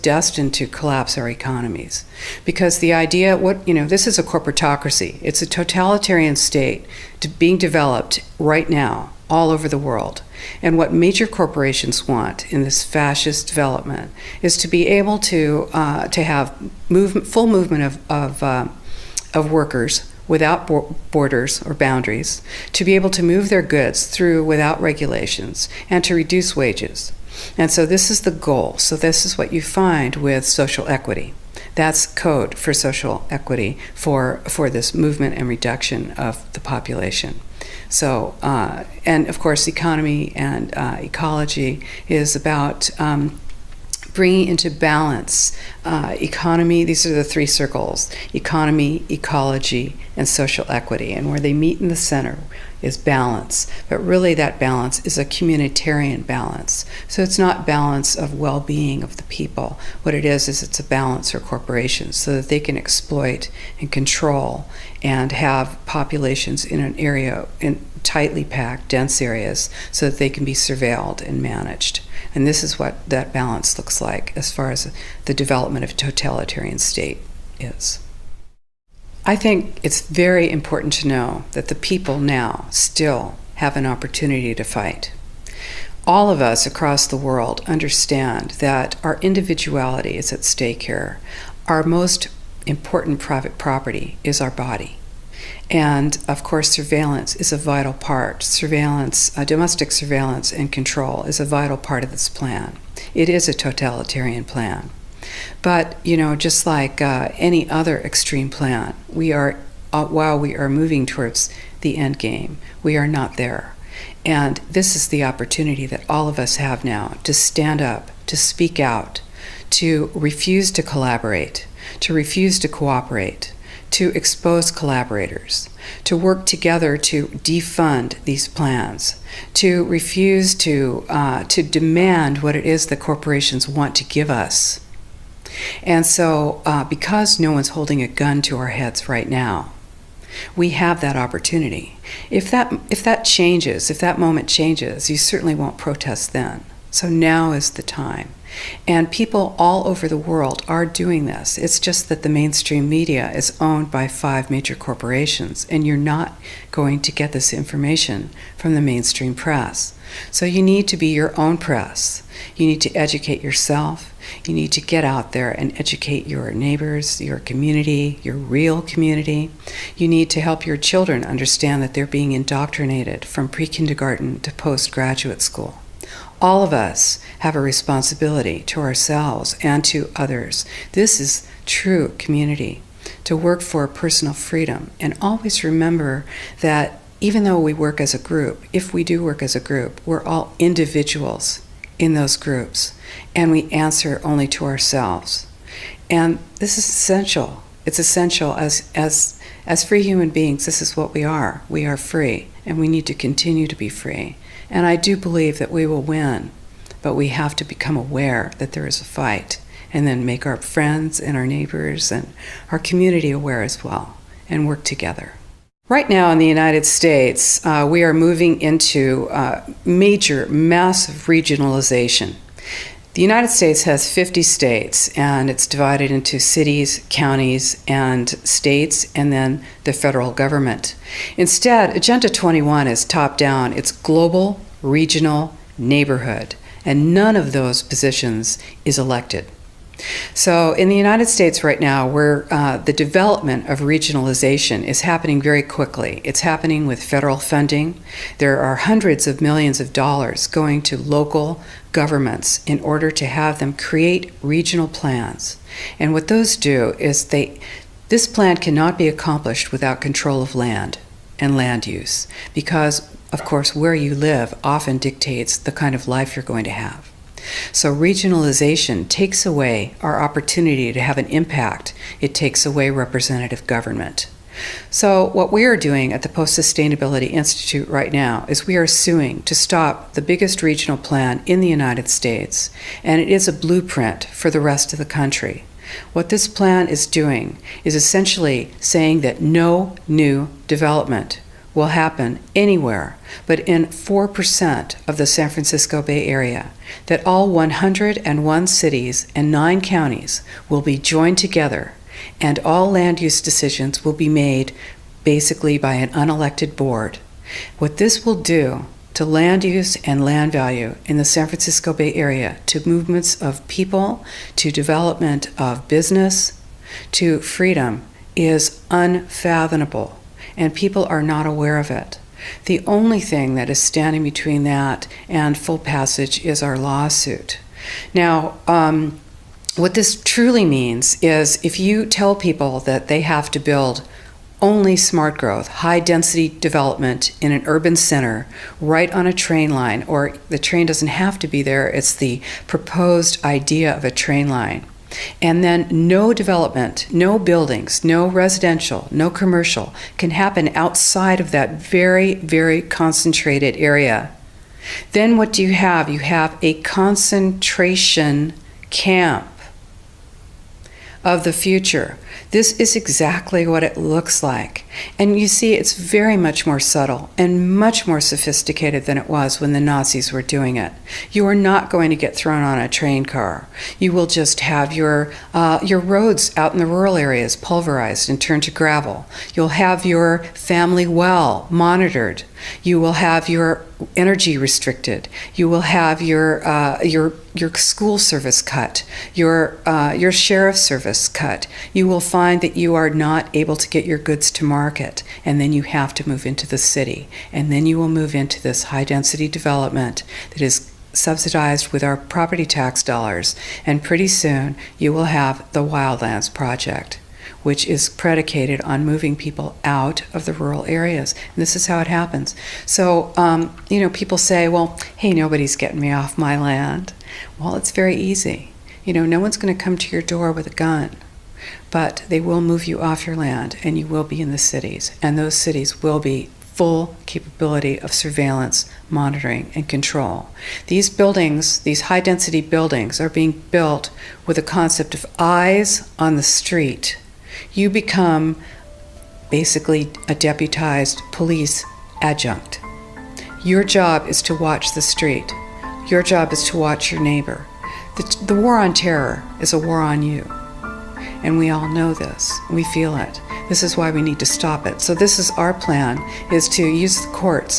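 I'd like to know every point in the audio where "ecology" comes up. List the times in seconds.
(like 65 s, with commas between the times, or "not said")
40 s, 49 s.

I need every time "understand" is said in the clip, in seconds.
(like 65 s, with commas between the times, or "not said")
87 s, 171 s.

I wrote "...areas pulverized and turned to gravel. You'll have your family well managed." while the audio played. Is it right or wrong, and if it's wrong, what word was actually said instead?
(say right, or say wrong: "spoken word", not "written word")
wrong: "monitored", not "managed".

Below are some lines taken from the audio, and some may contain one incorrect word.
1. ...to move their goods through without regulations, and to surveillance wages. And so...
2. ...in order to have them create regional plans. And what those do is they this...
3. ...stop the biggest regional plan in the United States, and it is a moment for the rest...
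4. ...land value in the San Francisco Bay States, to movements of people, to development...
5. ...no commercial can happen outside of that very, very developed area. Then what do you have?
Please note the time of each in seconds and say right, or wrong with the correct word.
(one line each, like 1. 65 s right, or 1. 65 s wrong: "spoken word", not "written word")
1. 23 s wrong: "reduce", not "surveillance"
2. 252 s right
3. 279 s wrong: "blueprint", not "moment"
4. 310 s wrong: "Area", not "States"
5. 349 s wrong: "concentrated", not "developed".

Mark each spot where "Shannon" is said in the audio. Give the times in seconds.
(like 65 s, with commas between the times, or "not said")
not said.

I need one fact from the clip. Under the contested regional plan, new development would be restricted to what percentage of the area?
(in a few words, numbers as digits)
4%.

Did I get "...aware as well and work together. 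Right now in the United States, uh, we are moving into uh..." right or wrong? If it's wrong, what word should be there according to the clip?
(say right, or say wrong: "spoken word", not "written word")
right.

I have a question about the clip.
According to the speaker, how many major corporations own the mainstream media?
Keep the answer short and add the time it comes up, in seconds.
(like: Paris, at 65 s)
5, at 154 s.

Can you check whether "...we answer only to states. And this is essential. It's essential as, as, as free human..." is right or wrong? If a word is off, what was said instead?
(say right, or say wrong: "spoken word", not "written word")
wrong: "ourselves", not "states".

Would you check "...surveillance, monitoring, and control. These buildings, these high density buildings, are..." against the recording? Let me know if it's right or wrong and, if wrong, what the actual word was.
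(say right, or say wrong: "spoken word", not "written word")
right.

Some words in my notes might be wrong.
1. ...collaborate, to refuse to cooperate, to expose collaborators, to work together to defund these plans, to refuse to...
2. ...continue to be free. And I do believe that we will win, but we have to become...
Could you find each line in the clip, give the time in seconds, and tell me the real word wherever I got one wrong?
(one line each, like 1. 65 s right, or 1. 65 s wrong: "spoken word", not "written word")
1. 120 s right
2. 203 s right.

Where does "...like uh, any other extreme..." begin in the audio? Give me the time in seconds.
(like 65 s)
106 s.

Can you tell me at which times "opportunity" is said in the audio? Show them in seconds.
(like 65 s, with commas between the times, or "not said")
83 s, 115 s, 141 s, 270 s.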